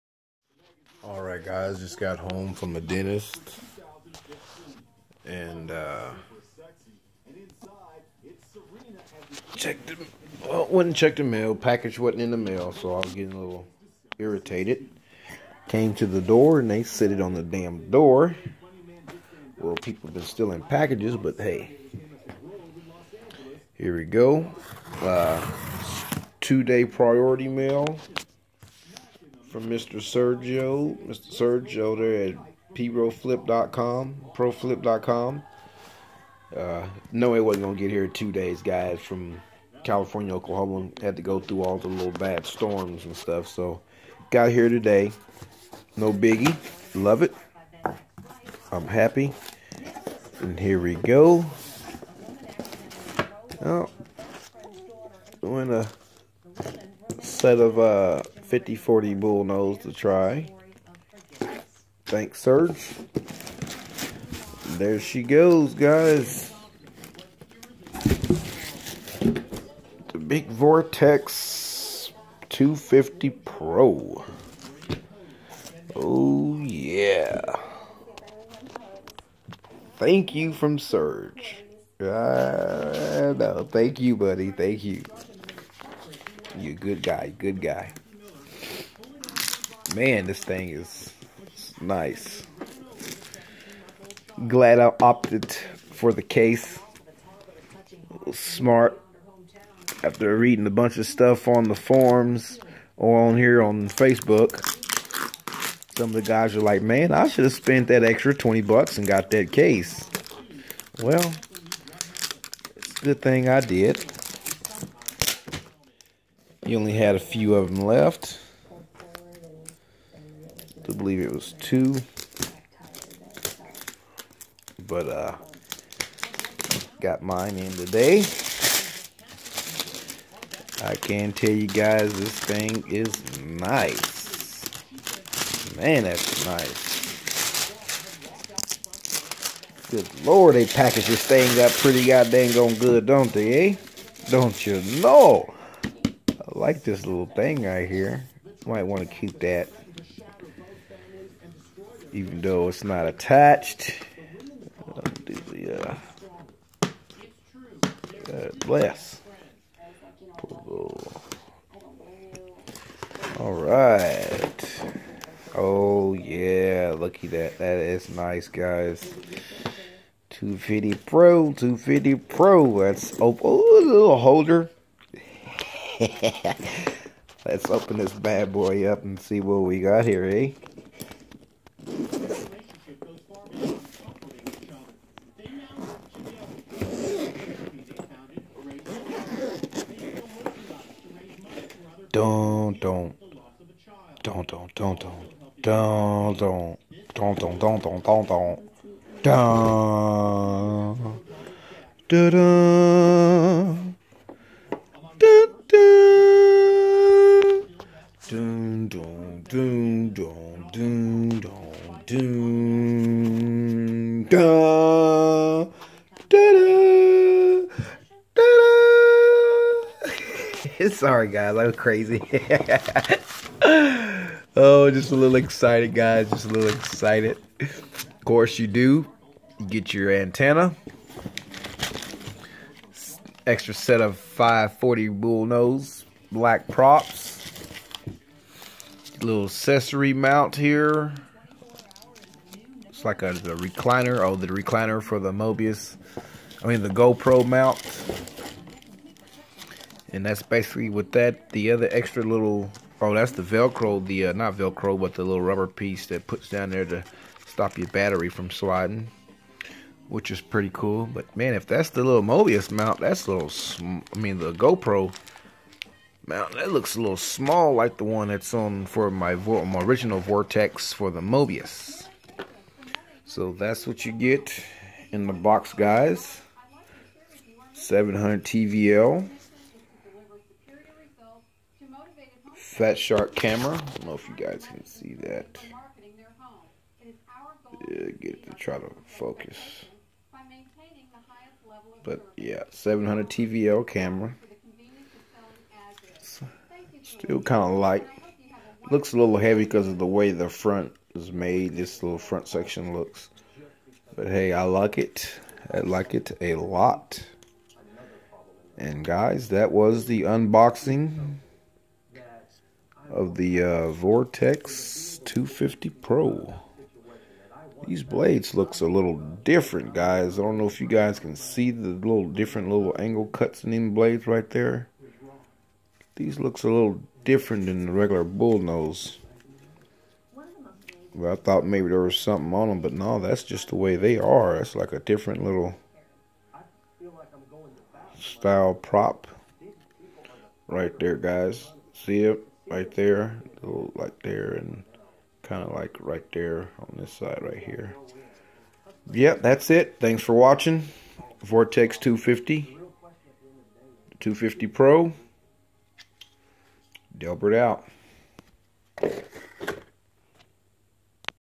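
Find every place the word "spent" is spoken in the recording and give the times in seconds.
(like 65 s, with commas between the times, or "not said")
107 s.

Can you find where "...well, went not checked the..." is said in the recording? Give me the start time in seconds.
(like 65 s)
10 s.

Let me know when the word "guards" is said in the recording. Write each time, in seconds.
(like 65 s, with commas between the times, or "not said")
not said.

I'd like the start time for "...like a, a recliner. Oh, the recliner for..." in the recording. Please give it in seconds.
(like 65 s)
243 s.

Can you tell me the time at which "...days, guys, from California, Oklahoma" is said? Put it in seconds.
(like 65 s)
38 s.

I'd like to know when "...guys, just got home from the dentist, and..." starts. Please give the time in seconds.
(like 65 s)
1 s.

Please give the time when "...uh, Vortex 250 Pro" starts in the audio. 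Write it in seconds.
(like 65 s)
313 s.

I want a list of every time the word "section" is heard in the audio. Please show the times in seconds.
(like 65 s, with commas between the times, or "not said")
302 s.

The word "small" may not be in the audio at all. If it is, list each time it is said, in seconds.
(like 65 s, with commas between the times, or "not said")
267 s.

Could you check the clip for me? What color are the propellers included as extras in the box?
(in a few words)
Black.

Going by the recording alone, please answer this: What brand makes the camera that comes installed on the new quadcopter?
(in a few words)
Fat Shark.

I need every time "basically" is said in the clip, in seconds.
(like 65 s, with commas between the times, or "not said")
250 s.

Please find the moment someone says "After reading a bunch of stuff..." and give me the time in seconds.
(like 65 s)
100 s.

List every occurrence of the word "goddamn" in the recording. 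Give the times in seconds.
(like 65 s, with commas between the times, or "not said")
142 s.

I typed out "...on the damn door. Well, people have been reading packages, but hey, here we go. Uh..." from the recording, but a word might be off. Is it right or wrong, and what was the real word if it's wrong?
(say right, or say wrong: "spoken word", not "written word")
wrong: "stealing", not "reading".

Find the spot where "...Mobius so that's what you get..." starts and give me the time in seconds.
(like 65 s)
271 s.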